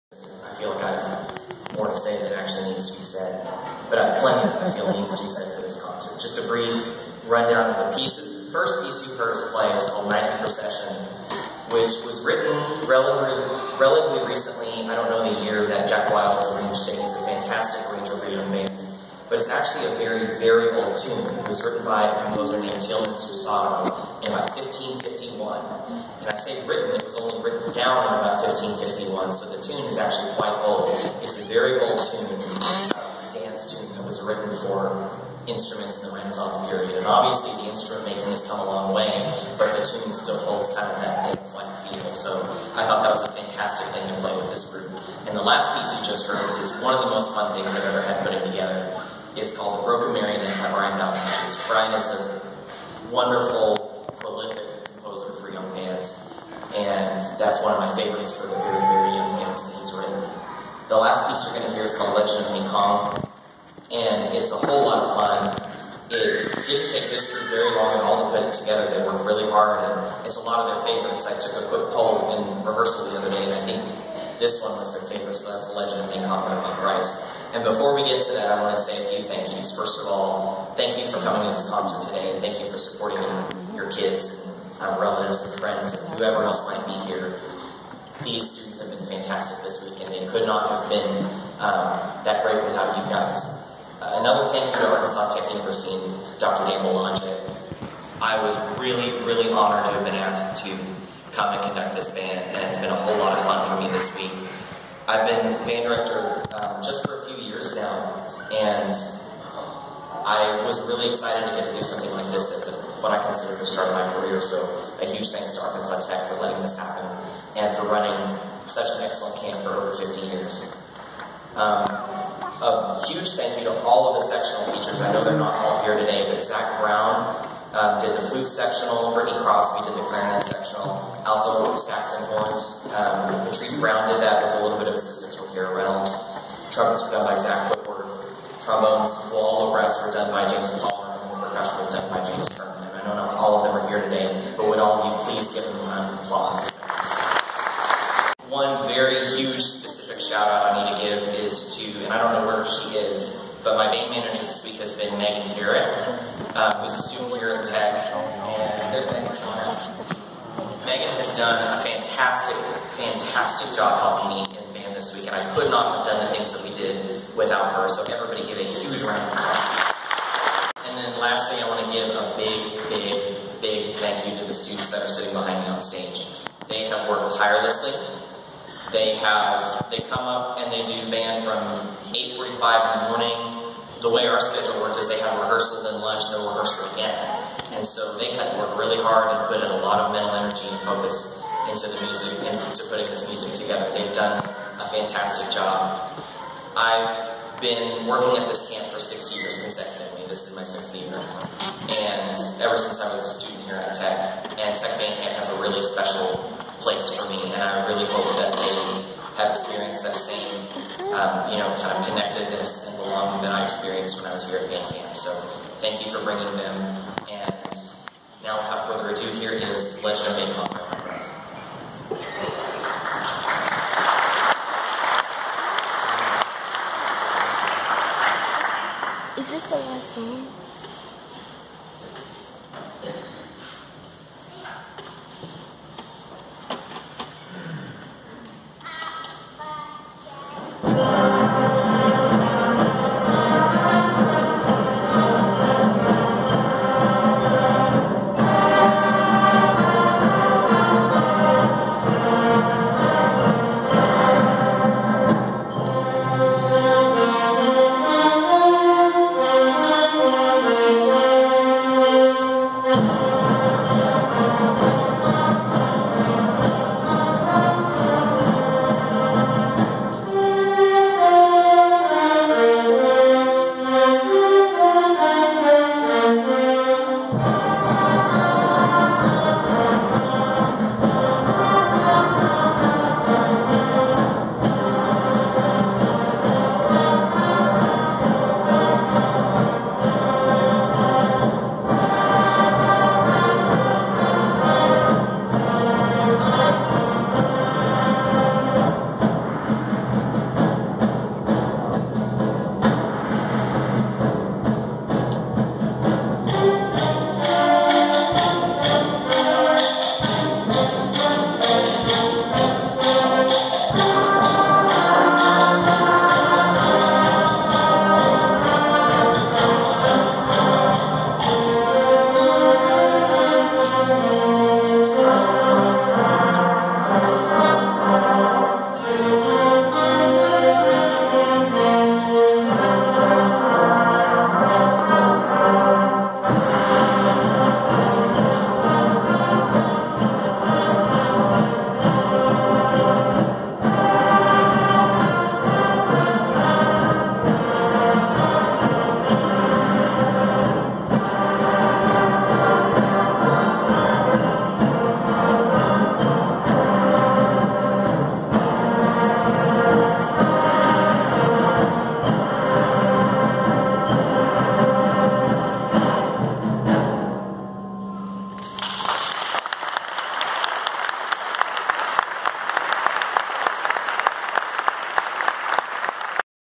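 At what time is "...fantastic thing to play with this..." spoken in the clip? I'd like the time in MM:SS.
00:43.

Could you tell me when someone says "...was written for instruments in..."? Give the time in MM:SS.
00:34.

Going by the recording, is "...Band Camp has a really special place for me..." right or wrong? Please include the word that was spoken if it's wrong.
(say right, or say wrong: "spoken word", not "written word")
right.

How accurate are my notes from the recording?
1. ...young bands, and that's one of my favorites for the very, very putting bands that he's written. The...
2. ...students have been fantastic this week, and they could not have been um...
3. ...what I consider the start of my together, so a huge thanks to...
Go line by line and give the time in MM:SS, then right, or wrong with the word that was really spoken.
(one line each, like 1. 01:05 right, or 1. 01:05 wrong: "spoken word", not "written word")
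1. 00:55 wrong: "young", not "putting"
2. 01:28 right
3. 01:53 wrong: "career", not "together".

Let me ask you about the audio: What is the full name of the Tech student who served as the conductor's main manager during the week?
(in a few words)
Megan Garrett.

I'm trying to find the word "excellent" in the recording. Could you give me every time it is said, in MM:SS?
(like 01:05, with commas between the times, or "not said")
01:59.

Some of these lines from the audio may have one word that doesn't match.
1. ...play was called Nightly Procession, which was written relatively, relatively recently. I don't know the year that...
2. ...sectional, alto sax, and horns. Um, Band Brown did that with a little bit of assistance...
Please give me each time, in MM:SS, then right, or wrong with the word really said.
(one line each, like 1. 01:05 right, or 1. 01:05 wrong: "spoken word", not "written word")
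1. 00:09 right
2. 02:10 wrong: "Patrice", not "Band".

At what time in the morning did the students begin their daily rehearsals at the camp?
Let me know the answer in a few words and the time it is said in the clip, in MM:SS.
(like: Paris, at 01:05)
8:45, at 03:02.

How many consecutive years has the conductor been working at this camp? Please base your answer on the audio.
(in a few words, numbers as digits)
6.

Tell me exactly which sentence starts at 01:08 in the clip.
They worked really hard, and it's a lot of their favorites.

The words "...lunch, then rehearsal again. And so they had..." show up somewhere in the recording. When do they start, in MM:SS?
03:06.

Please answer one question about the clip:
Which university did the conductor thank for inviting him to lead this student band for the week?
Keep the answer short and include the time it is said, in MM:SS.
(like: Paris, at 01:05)
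Arkansas Tech University, at 01:34.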